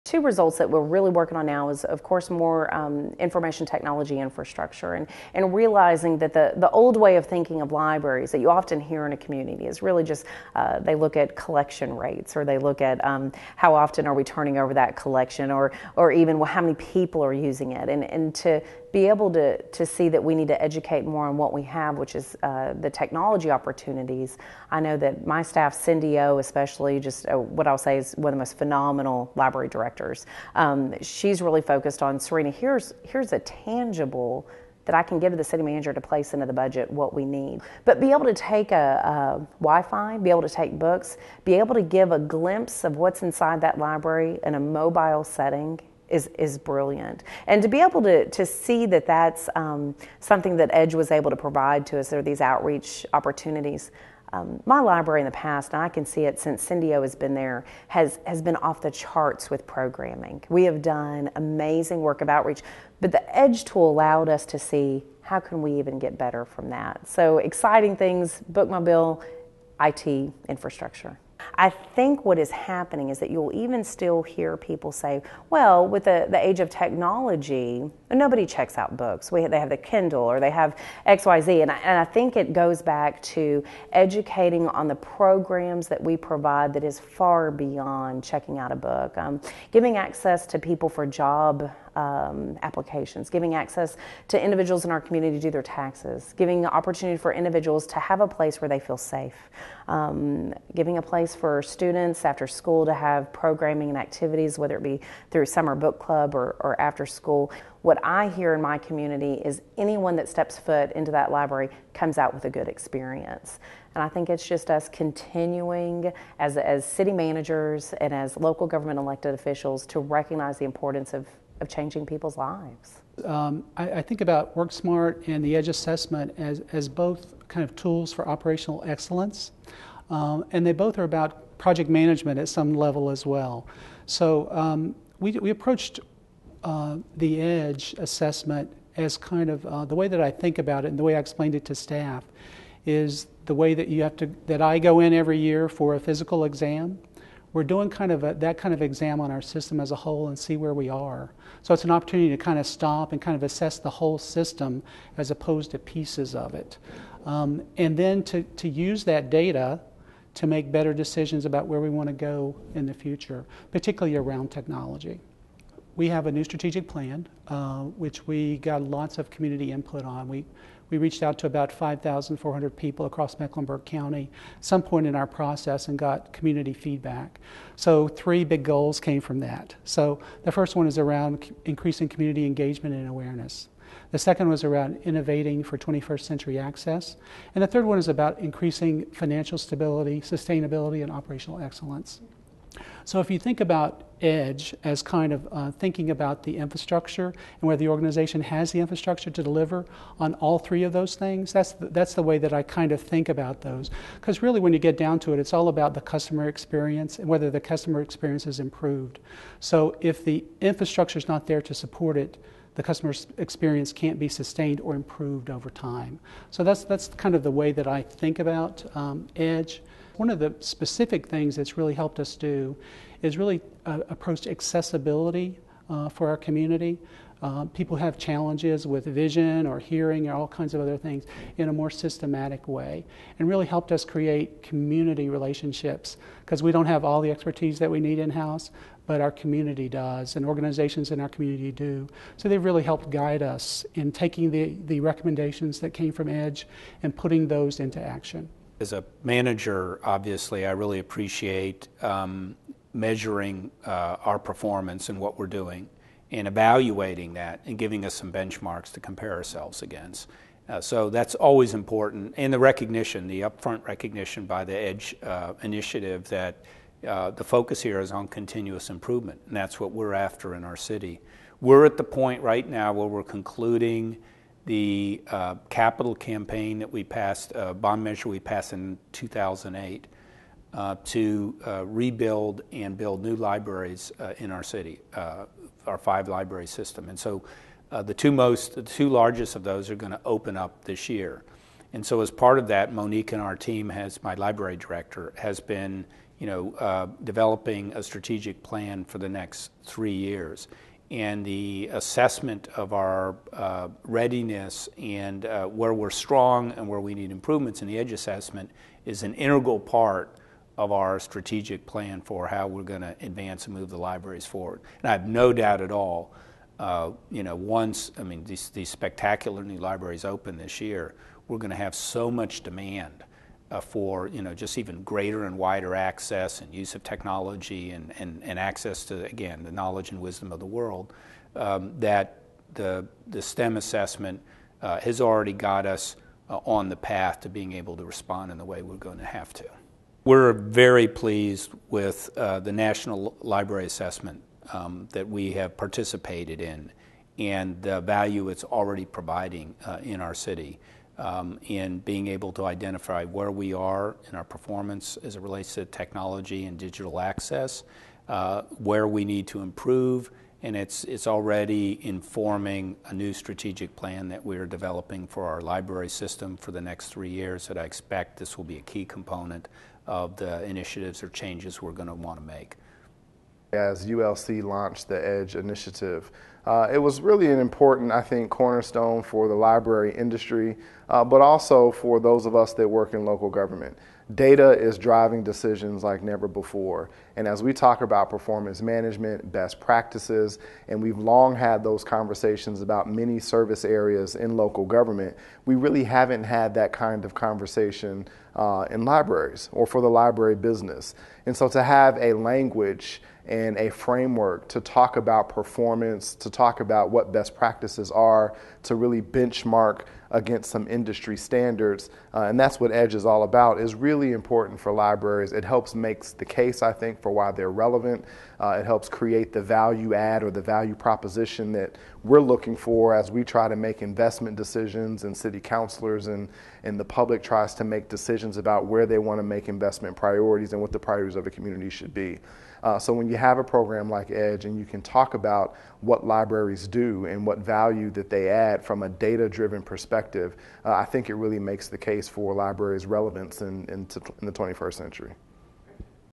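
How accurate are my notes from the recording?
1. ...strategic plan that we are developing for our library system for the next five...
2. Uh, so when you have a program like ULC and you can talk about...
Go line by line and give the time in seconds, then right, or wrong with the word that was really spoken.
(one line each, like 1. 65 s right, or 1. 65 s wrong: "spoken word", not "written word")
1. 363 s wrong: "three", not "five"
2. 432 s wrong: "Edge", not "ULC".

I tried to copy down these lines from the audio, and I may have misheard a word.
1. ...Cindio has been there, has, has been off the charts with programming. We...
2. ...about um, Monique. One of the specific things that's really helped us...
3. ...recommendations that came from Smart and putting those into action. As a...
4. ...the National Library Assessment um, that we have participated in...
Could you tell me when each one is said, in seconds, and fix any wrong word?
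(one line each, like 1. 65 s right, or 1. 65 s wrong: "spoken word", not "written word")
1. 56 s right
2. 218 s wrong: "Edge", not "Monique"
3. 244 s wrong: "EDGE", not "Smart"
4. 342 s right.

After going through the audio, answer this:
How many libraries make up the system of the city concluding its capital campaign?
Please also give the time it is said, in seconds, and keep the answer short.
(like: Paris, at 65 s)
five, at 285 s.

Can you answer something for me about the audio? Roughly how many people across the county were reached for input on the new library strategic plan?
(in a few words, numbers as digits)
5,400.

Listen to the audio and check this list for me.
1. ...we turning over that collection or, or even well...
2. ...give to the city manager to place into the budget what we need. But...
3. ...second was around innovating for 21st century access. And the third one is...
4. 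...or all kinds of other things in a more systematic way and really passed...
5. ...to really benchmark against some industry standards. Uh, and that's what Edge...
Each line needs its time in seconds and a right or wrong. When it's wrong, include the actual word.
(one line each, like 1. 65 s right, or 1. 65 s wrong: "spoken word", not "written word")
1. 14 s right
2. 35 s right
3. 184 s right
4. 230 s wrong: "helped", not "passed"
5. 408 s right.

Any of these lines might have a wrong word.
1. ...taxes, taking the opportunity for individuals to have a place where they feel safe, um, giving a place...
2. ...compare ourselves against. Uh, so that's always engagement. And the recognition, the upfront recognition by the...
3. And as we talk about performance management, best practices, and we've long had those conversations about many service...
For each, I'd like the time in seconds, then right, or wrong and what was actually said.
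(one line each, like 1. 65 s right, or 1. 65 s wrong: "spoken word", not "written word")
1. 95 s wrong: "giving", not "taking"
2. 258 s wrong: "important", not "engagement"
3. 387 s right.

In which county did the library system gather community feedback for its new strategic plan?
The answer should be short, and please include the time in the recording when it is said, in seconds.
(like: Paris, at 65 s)
Mecklenburg County, at 173 s.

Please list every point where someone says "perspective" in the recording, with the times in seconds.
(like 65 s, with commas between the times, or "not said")
439 s.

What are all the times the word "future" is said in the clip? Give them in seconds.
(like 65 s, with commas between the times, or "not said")
162 s.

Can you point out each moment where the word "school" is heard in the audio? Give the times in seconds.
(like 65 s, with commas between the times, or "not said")
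102 s, 107 s.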